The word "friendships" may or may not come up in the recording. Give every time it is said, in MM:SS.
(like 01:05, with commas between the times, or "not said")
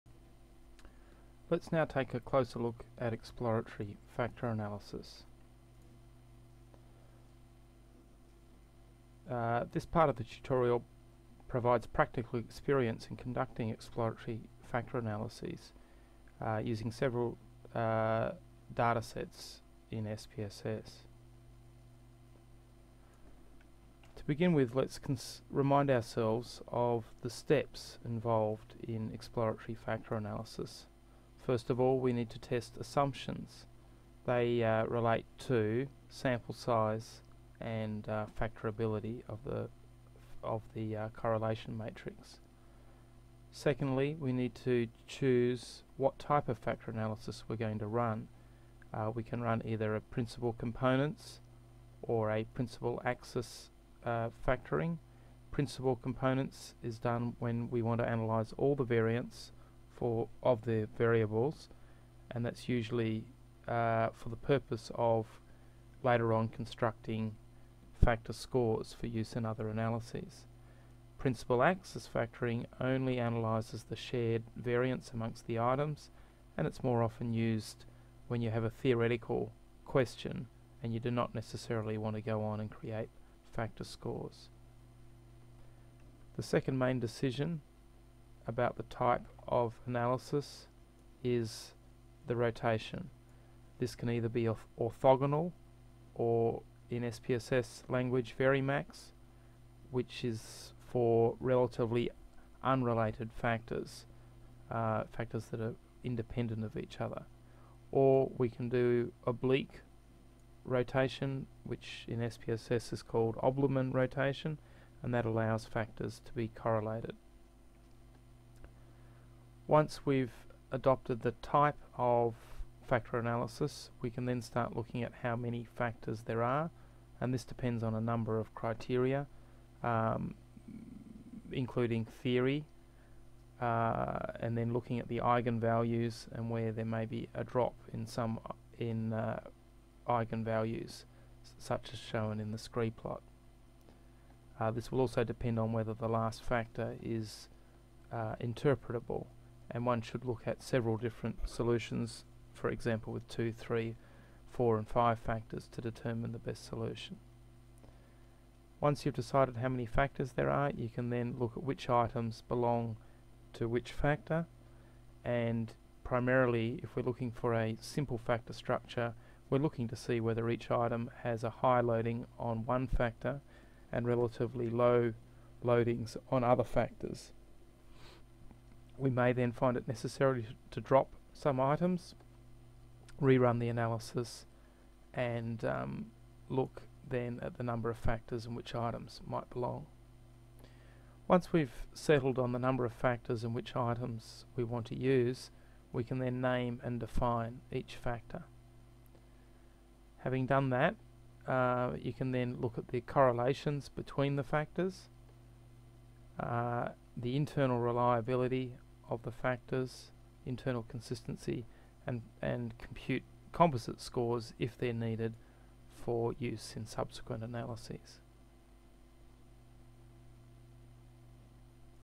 not said.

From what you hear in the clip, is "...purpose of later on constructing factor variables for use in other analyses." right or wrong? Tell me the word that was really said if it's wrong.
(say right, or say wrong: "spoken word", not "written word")
wrong: "scores", not "variables".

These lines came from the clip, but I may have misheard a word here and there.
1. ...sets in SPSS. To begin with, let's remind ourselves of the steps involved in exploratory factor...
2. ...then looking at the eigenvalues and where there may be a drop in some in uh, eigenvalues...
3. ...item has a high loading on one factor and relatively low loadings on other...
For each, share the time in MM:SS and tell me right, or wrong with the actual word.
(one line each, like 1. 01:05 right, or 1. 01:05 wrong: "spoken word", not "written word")
1. 00:19 right
2. 02:14 right
3. 02:50 right.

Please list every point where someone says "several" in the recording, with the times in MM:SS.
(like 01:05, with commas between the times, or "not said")
00:16, 02:30.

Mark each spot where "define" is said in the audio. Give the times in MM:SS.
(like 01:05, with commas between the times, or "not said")
03:16.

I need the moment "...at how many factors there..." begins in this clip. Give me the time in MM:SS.
02:05.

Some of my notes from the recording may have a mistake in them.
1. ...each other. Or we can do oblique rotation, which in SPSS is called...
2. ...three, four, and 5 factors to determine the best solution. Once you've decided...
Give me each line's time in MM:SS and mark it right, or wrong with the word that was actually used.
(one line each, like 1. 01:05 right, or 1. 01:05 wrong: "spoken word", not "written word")
1. 01:46 right
2. 02:33 right.